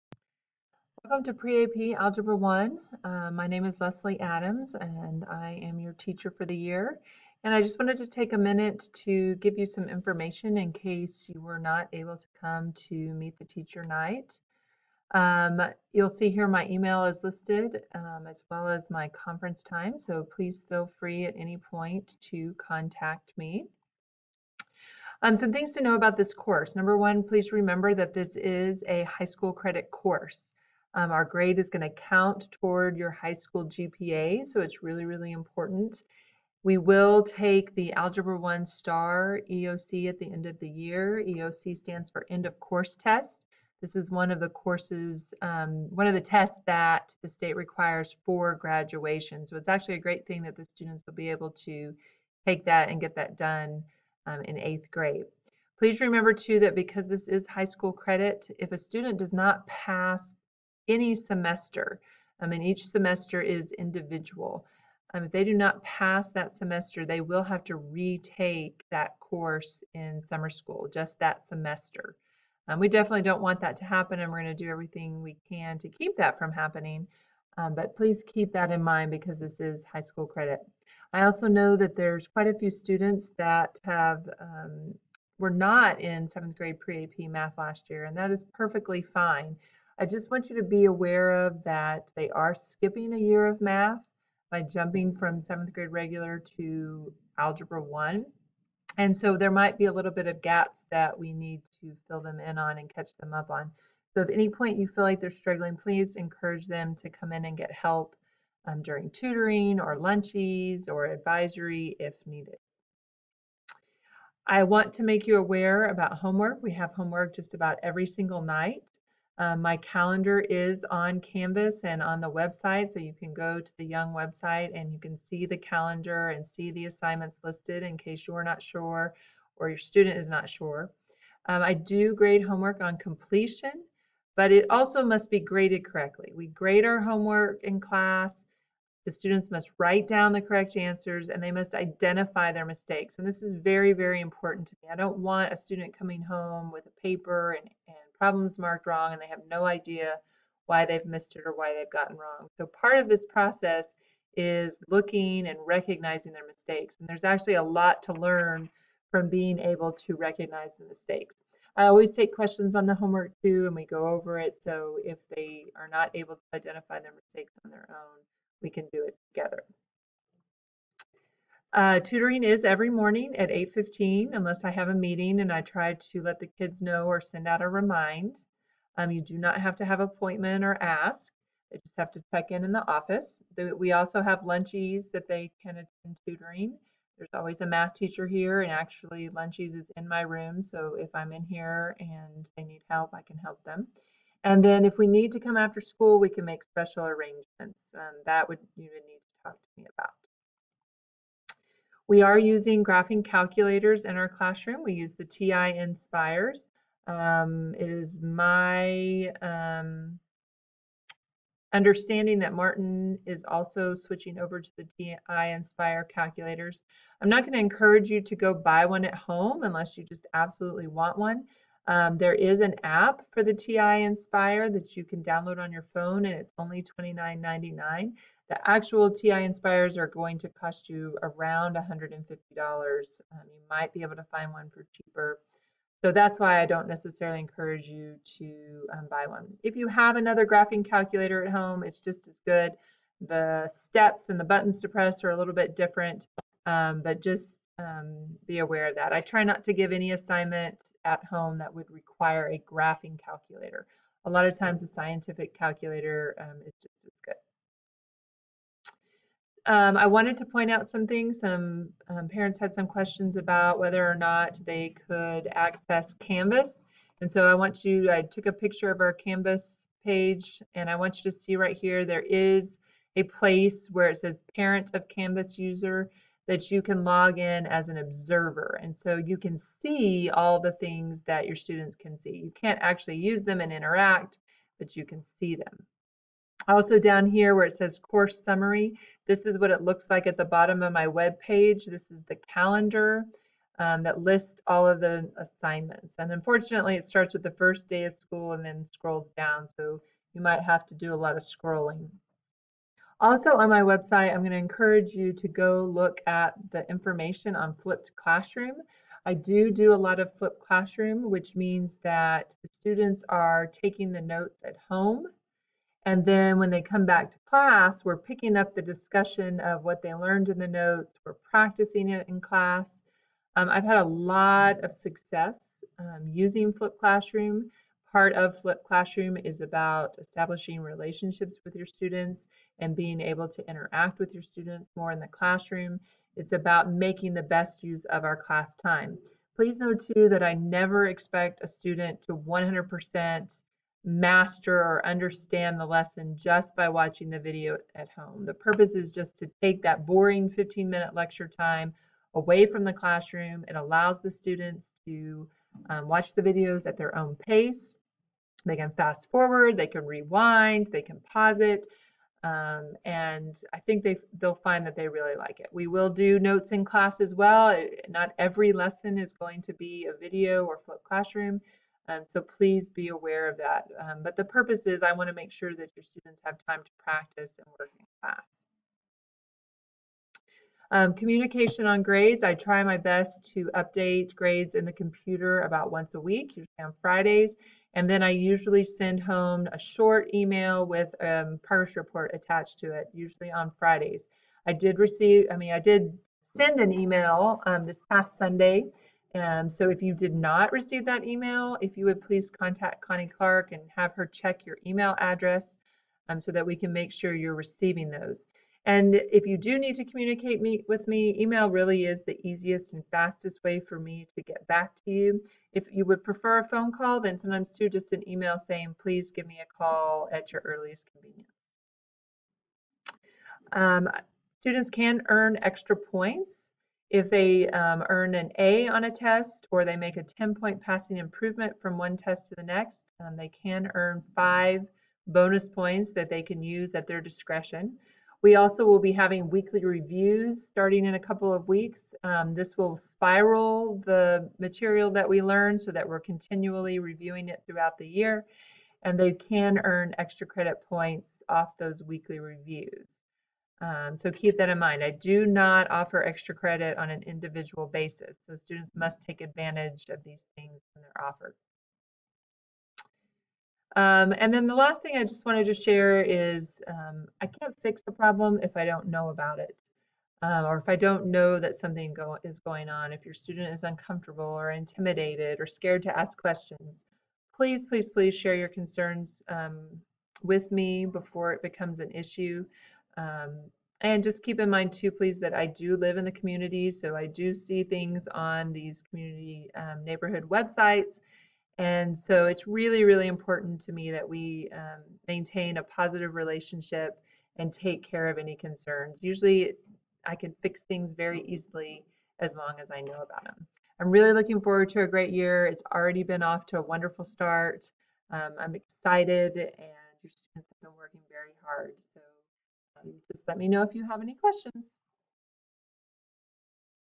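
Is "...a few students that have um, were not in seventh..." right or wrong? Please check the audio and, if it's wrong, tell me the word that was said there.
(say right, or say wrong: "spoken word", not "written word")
right.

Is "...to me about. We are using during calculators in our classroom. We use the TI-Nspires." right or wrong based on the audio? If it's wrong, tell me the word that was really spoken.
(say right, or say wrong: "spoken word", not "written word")
wrong: "graphing", not "during".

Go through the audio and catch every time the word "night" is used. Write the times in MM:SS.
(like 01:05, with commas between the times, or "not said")
00:13, 01:58.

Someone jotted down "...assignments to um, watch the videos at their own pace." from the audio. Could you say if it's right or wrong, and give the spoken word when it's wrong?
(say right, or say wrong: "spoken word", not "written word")
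wrong: "students", not "assignments".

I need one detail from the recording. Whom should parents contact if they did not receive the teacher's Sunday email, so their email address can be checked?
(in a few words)
Connie Clark.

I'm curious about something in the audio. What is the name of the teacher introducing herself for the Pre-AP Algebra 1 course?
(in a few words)
Leslie Adams.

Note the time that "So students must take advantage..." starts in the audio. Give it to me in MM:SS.
07:38.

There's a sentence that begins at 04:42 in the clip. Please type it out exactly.
You can't actually use them and interact, but you can see them.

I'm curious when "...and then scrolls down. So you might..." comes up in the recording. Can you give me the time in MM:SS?
04:58.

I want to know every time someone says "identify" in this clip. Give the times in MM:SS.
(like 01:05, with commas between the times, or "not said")
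02:21, 02:46.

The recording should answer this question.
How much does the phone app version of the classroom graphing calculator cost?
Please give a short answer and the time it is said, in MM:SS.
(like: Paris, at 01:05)
$29.99, at 03:46.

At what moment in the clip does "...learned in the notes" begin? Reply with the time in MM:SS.
05:20.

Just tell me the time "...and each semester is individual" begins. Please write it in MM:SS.
01:02.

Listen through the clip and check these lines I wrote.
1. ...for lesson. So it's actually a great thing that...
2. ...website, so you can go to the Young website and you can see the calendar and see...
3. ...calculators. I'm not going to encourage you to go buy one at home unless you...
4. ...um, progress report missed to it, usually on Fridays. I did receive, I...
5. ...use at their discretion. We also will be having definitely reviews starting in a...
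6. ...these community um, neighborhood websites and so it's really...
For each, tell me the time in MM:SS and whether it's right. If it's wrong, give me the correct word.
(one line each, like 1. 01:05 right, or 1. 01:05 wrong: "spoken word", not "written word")
1. 00:48 wrong: "graduation", not "lesson"
2. 02:02 right
3. 03:36 right
4. 06:31 wrong: "attached", not "missed"
5. 07:16 wrong: "weekly", not "definitely"
6. 08:08 right.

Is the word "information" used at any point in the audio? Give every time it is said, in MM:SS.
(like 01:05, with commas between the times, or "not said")
00:09, 05:06.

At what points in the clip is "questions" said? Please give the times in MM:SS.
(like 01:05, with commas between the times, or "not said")
02:42, 04:22, 07:56, 08:34.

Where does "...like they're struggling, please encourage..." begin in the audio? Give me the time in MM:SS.
01:45.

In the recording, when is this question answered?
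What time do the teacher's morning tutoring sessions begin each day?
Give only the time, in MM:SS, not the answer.
02:53.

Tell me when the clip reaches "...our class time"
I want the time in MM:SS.
05:38.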